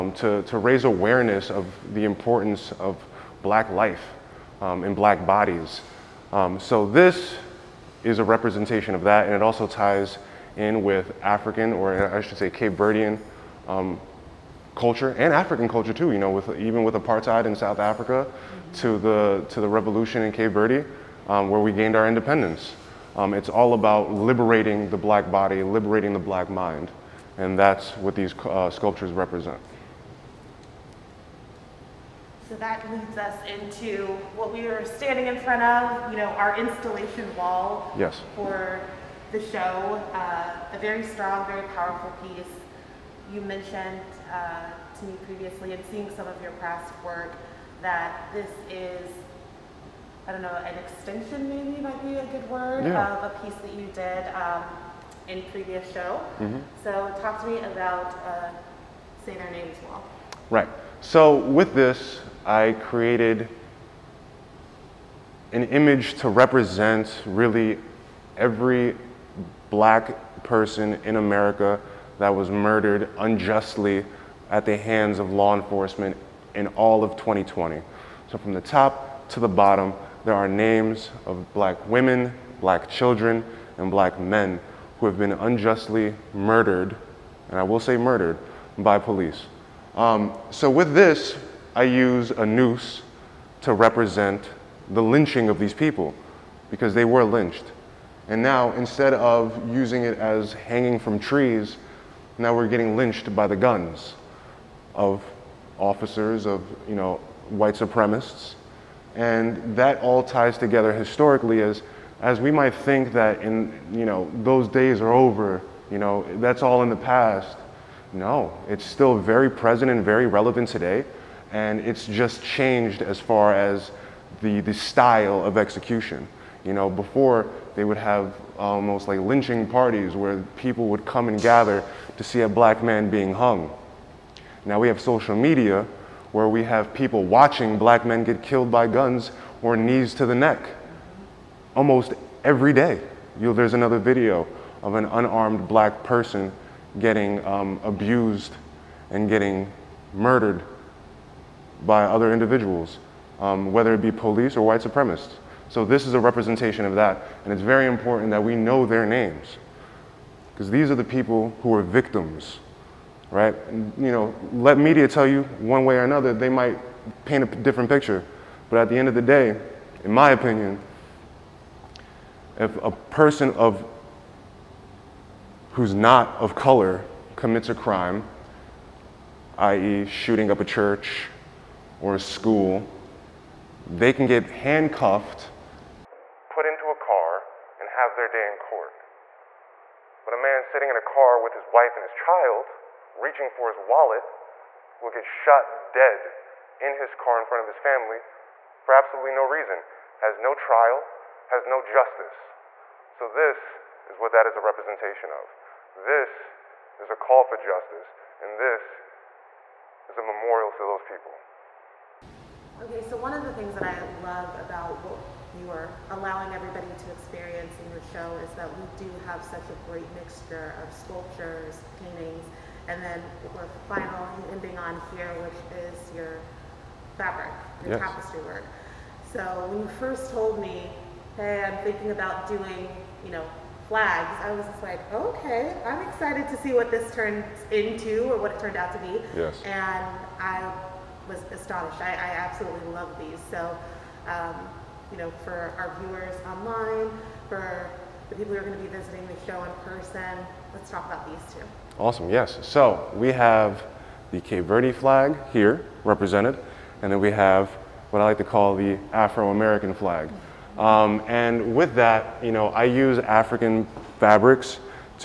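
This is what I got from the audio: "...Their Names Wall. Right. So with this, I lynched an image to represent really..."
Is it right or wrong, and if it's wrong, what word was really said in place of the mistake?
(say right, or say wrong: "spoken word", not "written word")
wrong: "created", not "lynched".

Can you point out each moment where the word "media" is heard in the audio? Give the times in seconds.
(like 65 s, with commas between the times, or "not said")
135 s, 164 s.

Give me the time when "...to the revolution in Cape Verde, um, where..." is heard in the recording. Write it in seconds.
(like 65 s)
19 s.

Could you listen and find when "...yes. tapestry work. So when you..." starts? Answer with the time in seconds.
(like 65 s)
227 s.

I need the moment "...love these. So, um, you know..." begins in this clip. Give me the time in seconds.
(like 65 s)
242 s.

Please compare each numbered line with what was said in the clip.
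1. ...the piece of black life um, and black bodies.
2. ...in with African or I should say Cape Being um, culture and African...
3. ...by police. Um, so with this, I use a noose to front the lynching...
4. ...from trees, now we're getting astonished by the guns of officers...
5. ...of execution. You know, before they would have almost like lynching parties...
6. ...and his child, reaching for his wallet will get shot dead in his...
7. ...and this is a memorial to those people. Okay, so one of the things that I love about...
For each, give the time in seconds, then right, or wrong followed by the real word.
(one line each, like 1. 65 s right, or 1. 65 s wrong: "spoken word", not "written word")
1. 1 s wrong: "importance", not "piece"
2. 10 s wrong: "Verdean", not "Being"
3. 88 s wrong: "represent", not "front"
4. 100 s wrong: "lynched", not "astonished"
5. 125 s right
6. 191 s right
7. 208 s right.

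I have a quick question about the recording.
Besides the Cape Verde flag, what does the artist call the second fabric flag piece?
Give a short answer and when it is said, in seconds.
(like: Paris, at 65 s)
Afro-American flag, at 259 s.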